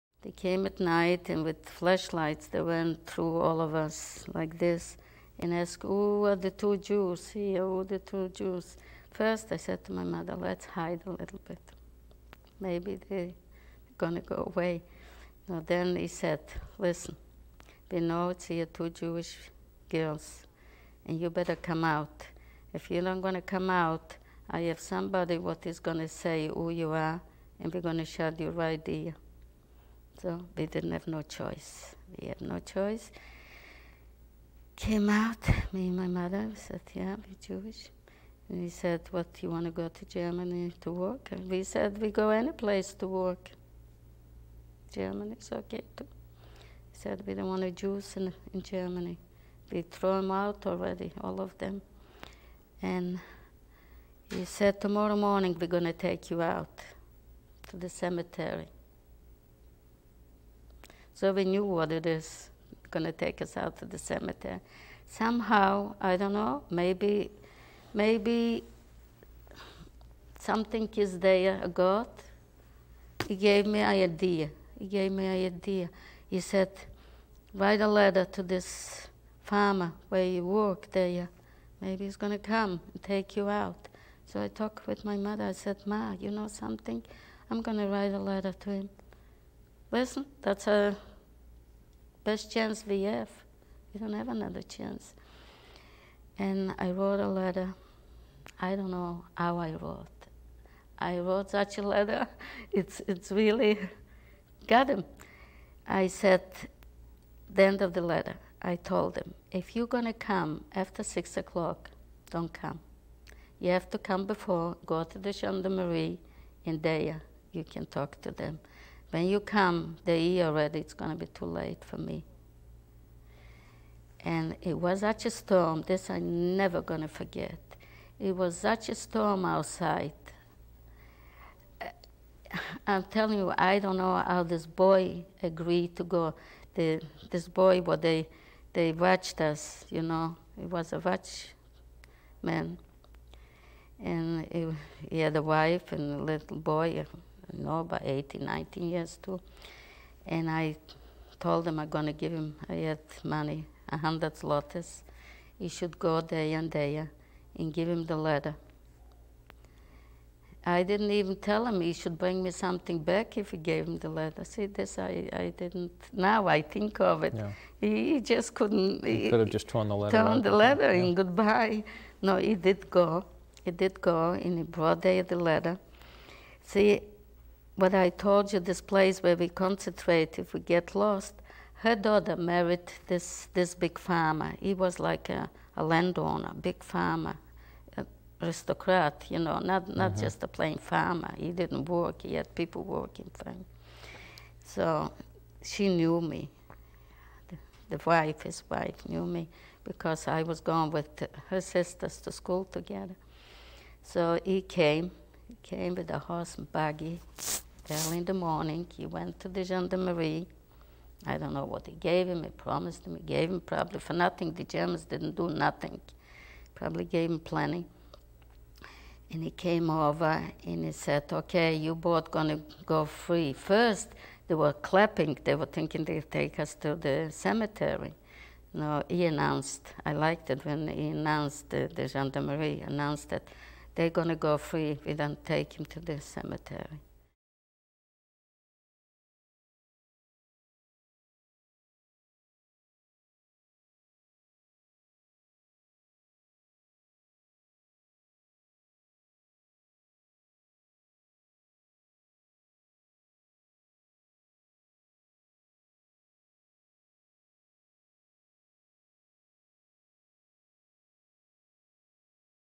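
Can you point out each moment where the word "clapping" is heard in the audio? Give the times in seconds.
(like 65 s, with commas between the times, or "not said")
224 s.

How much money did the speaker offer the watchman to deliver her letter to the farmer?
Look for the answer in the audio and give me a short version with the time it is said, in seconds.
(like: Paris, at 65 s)
100 zlotys, at 153 s.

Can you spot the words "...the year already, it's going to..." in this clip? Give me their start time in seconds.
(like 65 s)
120 s.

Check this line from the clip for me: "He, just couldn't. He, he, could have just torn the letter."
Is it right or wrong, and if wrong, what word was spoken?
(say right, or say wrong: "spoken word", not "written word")
right.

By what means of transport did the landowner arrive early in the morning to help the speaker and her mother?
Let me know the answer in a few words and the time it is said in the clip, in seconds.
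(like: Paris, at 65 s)
horse and buggy, at 206 s.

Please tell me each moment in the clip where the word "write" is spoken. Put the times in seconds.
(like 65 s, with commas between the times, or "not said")
77 s, 87 s.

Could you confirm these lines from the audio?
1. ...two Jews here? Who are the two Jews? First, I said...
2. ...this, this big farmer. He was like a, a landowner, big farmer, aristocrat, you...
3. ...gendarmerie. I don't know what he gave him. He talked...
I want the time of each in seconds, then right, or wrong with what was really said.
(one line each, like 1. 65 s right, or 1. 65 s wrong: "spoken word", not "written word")
1. 6 s right
2. 183 s right
3. 209 s wrong: "promised", not "talked".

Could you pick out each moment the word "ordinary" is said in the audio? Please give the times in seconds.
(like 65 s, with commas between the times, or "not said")
not said.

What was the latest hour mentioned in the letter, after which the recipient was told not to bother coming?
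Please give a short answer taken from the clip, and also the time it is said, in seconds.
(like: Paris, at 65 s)
6 o'clock, at 111 s.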